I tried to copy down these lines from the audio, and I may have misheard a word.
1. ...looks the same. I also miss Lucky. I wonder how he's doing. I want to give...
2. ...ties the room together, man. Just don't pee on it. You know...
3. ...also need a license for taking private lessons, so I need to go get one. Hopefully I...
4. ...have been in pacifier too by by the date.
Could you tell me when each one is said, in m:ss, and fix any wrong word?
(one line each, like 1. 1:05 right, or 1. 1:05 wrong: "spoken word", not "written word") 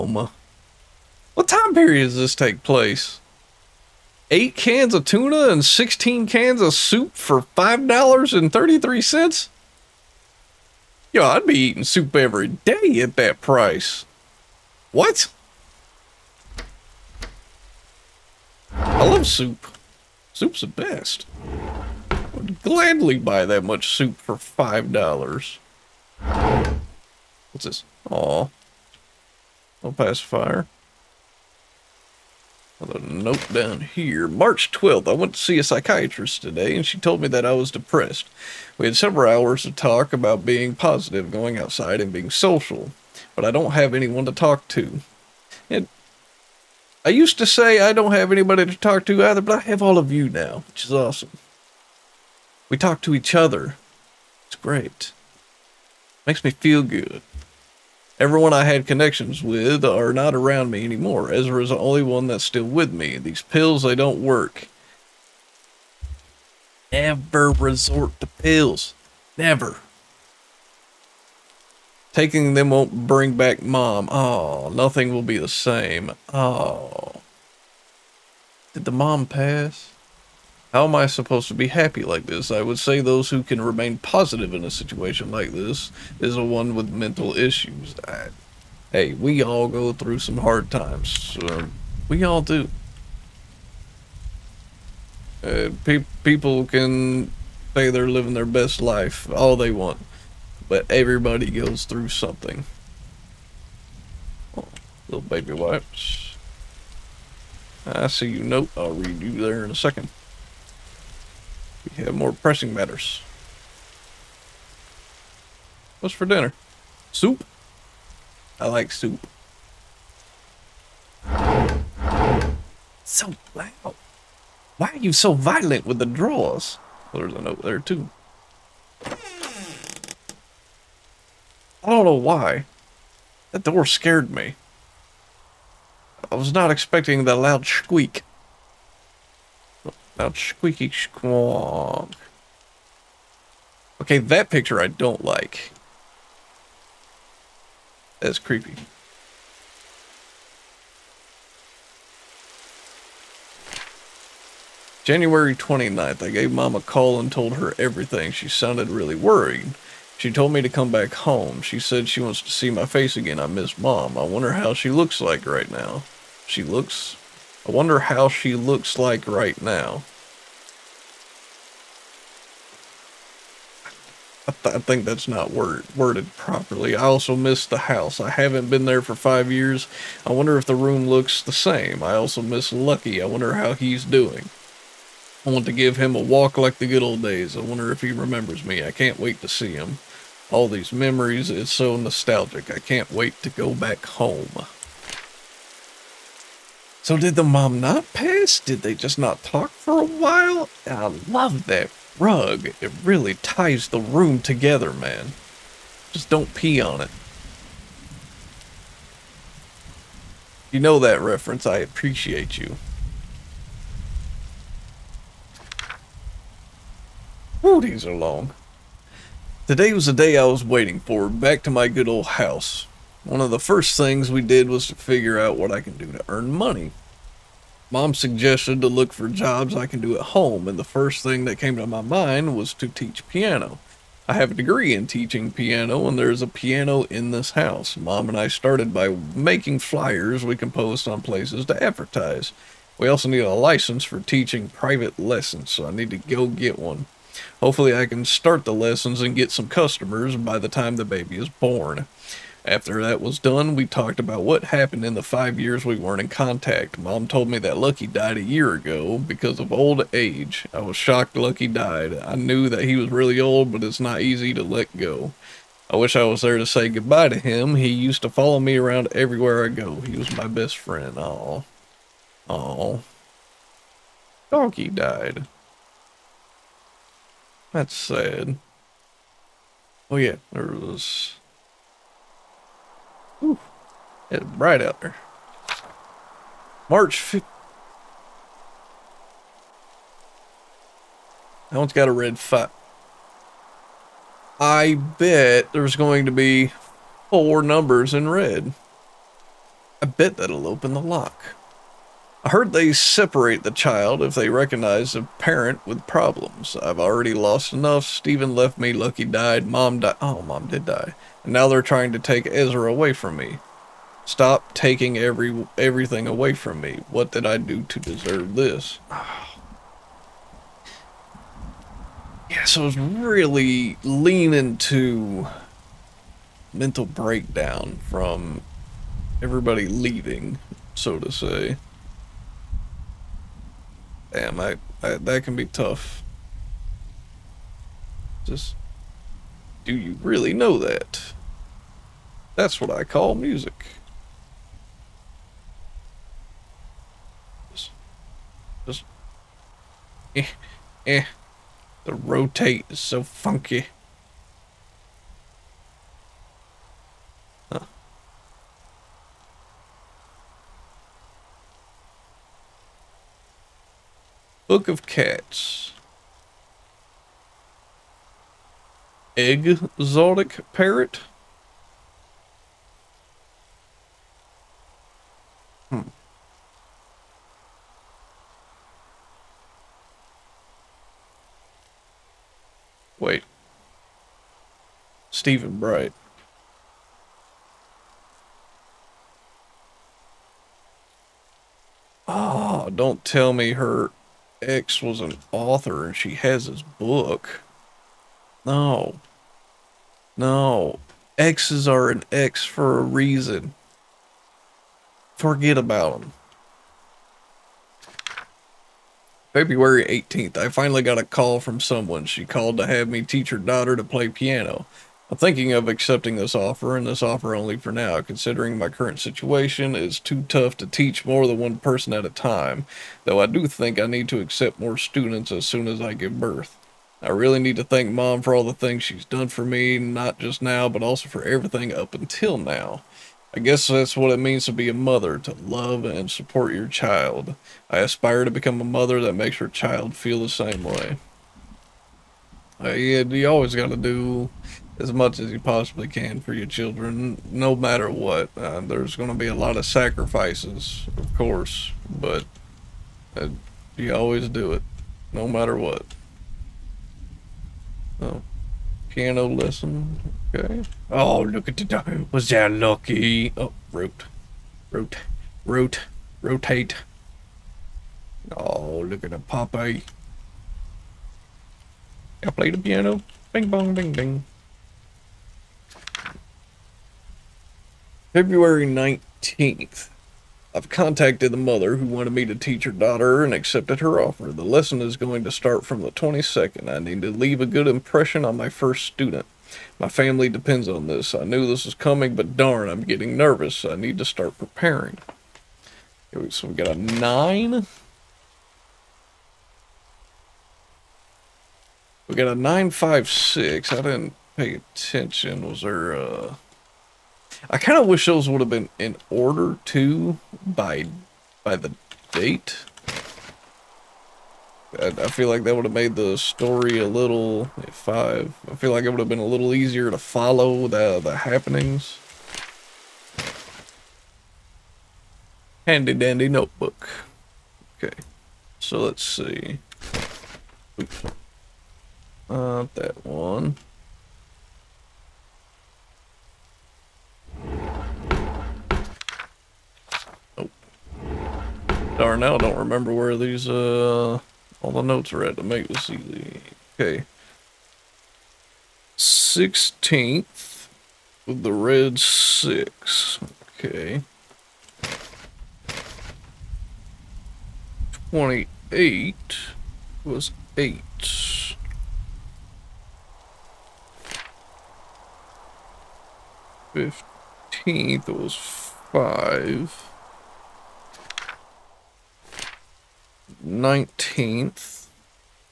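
1. 3:01 right
2. 3:23 right
3. 4:03 wrong: "teaching", not "taking"
4. 8:28 wrong: "order", not "pacifier".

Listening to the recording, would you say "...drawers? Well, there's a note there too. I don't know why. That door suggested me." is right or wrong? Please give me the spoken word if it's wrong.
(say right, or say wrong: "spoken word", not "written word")
wrong: "scared", not "suggested".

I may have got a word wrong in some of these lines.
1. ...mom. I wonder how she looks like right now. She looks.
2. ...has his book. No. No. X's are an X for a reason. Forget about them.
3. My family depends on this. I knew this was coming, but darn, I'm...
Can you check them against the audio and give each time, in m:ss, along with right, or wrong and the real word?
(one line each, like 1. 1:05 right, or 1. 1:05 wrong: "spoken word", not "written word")
1. 2:43 right
2. 6:36 right
3. 8:09 right.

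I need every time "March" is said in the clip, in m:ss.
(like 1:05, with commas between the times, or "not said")
0:34, 4:46.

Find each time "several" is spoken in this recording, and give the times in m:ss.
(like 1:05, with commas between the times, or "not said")
0:38.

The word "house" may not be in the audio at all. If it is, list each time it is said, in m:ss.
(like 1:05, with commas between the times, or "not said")
2:57, 3:42, 3:57.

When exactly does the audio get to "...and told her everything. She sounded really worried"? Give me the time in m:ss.
2:37.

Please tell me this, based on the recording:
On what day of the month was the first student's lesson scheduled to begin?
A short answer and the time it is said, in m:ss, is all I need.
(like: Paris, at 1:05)
22nd, at 8:06.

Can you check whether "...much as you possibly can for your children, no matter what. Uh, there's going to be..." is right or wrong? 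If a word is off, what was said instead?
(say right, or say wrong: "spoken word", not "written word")
right.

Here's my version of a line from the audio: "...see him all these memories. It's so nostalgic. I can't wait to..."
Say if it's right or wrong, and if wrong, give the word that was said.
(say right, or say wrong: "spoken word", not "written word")
right.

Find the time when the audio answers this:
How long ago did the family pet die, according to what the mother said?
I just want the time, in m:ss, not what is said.
4:18.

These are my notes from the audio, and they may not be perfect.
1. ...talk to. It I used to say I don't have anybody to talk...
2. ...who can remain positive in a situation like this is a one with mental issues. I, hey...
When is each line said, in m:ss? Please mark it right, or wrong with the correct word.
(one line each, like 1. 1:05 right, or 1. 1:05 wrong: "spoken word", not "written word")
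1. 0:44 right
2. 1:23 right.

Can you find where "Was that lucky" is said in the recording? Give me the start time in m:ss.
7:42.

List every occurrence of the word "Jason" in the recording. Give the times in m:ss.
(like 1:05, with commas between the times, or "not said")
not said.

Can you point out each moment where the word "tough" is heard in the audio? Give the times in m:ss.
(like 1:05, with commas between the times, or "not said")
5:35, 7:00.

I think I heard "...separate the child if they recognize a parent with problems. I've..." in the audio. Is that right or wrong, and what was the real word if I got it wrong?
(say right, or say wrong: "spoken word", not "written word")
right.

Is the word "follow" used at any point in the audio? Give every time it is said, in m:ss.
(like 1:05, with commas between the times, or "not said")
4:28, 8:40.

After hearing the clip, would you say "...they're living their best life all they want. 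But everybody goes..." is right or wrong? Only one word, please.
right.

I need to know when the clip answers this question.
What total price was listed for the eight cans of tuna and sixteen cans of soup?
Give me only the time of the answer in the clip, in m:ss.
0:07.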